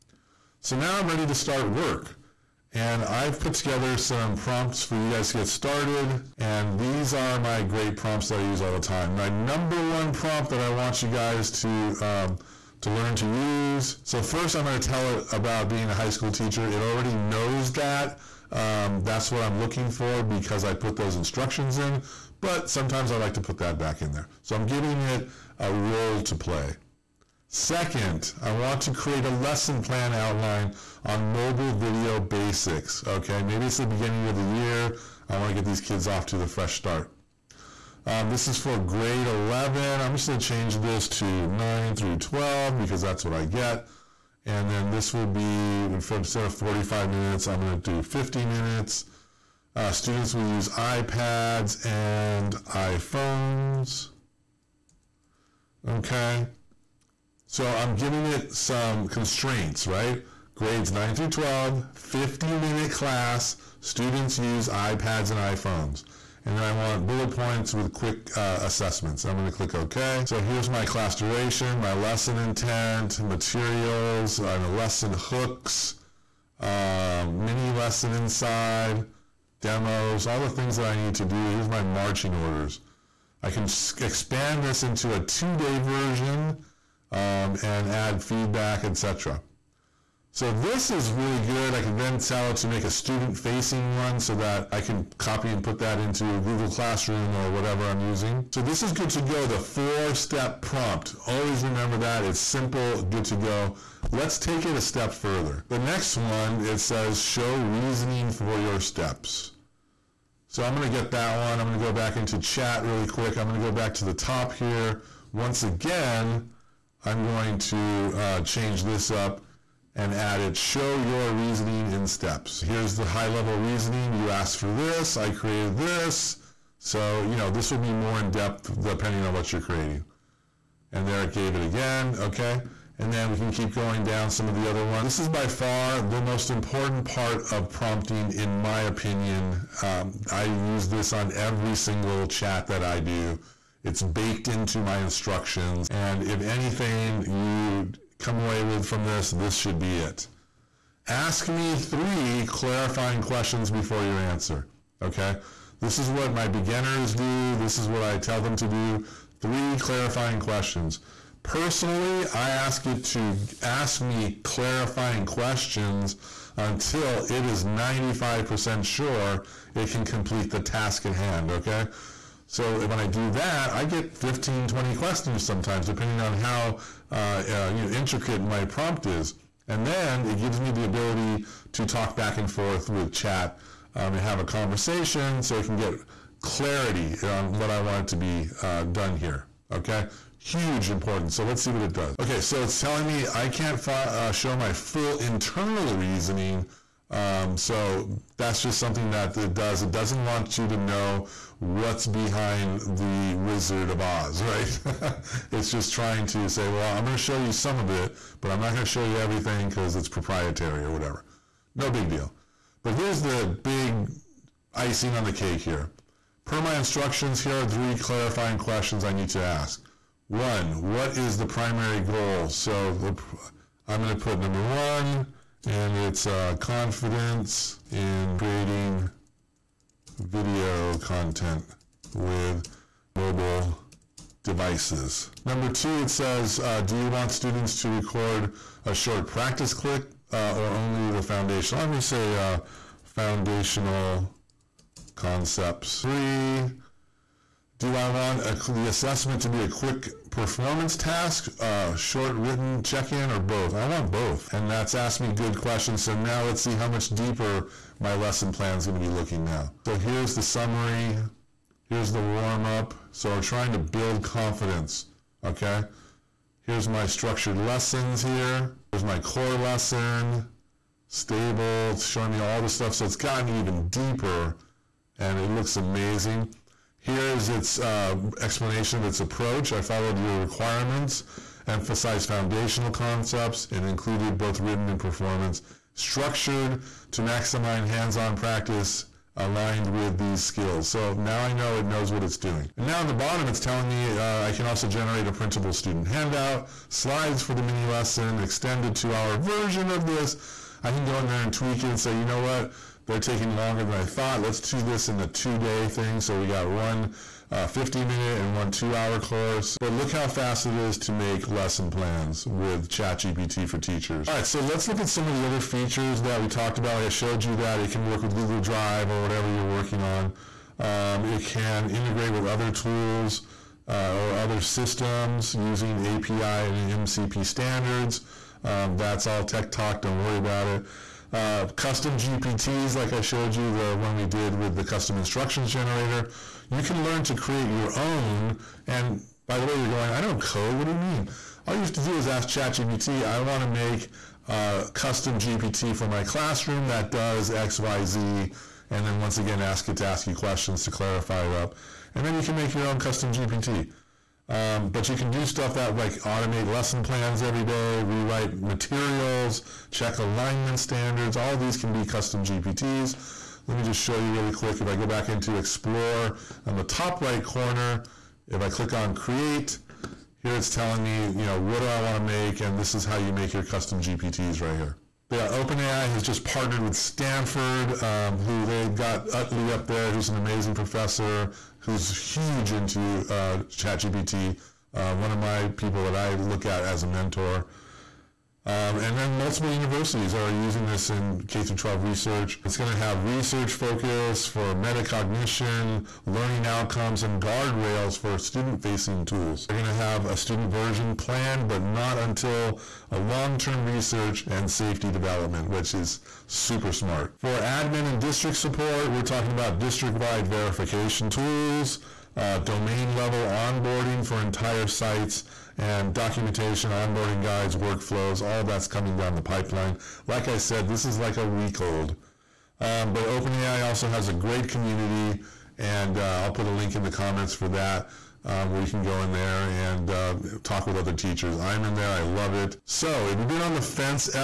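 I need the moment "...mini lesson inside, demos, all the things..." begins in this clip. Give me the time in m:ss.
1:17.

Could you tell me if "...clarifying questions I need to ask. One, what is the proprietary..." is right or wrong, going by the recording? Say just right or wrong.
wrong.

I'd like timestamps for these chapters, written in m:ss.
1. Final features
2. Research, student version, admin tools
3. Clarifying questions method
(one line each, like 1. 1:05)
1. 4:36
2. 6:36
3. 2:36.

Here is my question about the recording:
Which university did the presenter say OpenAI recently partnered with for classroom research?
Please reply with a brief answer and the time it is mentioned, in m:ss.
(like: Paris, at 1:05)
Stanford, at 6:16.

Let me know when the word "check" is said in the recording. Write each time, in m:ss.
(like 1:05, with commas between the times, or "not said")
4:12, 5:59.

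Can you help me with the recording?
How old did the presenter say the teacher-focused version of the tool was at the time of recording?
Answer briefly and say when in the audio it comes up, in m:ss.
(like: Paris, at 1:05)
A week old, at 7:01.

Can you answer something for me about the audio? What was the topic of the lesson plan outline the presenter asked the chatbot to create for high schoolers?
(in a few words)
Mobile video basics.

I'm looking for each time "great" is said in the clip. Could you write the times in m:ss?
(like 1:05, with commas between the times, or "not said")
0:07, 7:04.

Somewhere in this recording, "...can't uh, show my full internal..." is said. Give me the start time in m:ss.
3:13.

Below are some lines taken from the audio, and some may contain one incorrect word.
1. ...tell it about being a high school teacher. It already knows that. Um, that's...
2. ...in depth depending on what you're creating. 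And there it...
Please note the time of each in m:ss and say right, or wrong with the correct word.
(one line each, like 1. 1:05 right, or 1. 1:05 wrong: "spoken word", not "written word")
1. 0:14 right
2. 2:08 right.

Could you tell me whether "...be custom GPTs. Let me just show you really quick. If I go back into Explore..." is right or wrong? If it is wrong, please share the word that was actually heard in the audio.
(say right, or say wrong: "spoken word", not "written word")
right.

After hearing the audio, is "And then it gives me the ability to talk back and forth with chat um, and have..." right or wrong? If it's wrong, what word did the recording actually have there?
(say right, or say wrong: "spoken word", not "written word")
right.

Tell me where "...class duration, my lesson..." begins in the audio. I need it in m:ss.
1:10.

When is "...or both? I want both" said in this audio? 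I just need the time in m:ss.
4:13.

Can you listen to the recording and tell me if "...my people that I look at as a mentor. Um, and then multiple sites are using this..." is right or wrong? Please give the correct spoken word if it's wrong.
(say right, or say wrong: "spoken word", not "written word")
wrong: "universities", not "sites".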